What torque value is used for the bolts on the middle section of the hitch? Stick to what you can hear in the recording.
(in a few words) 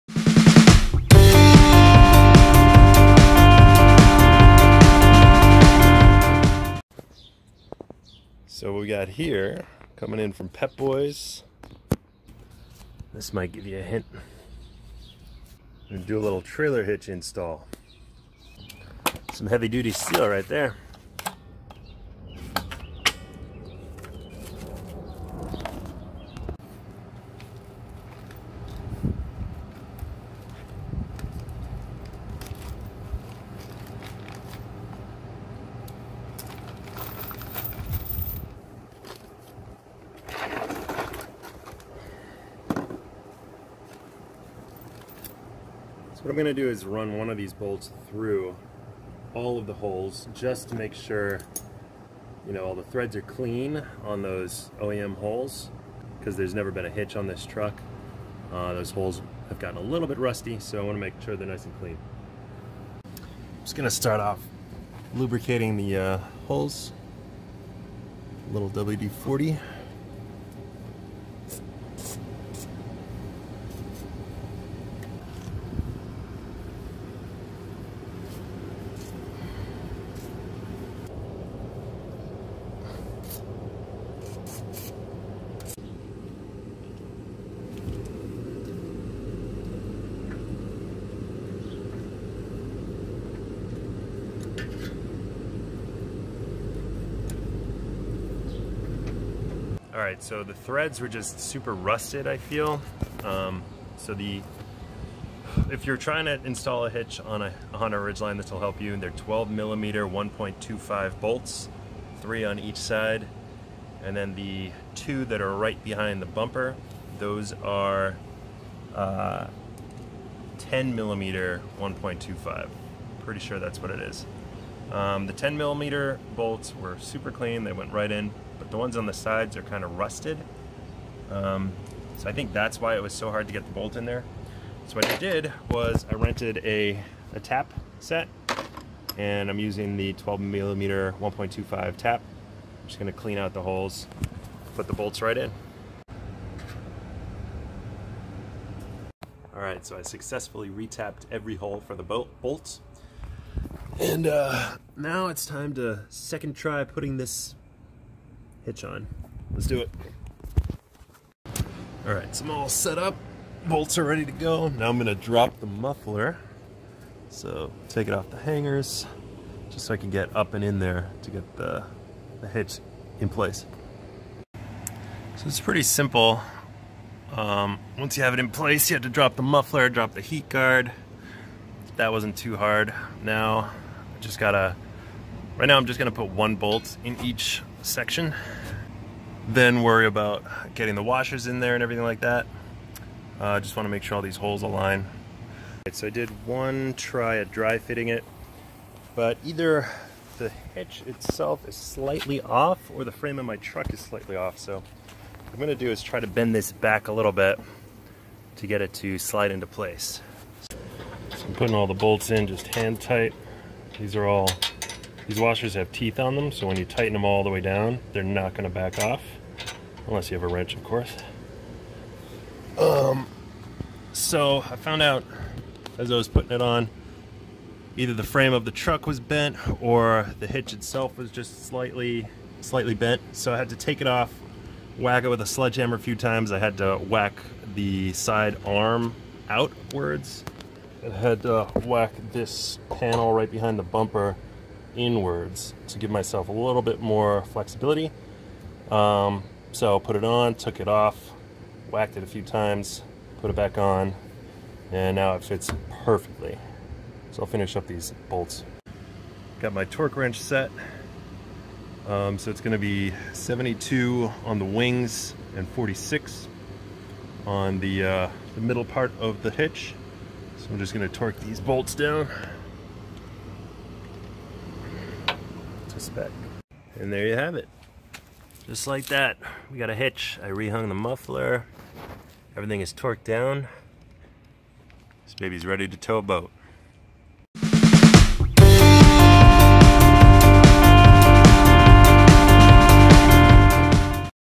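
46.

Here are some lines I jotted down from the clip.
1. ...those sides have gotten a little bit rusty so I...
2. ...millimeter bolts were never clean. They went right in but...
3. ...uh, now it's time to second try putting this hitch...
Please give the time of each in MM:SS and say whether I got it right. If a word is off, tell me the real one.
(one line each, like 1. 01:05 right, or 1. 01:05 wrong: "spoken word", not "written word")
1. 00:58 wrong: "holes", not "sides"
2. 02:05 wrong: "super", not "never"
3. 02:34 right.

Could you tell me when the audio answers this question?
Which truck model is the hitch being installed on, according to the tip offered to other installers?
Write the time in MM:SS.
01:47.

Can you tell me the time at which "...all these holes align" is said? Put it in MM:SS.
03:14.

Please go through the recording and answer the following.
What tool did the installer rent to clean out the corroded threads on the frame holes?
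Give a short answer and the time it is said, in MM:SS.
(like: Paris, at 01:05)
A tap set, at 02:17.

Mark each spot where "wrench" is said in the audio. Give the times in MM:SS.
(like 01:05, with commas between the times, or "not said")
03:40, 04:20.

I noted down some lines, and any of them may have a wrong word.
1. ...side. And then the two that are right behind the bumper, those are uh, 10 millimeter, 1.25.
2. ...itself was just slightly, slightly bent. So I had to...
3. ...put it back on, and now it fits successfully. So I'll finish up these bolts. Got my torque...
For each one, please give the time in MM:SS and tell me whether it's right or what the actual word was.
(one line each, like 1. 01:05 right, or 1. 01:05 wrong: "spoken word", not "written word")
1. 01:52 right
2. 03:50 right
3. 04:13 wrong: "perfectly", not "successfully".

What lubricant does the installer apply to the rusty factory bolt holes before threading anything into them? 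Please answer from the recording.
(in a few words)
WD-40.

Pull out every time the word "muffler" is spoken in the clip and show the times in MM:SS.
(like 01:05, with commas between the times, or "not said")
02:45, 02:59, 04:40.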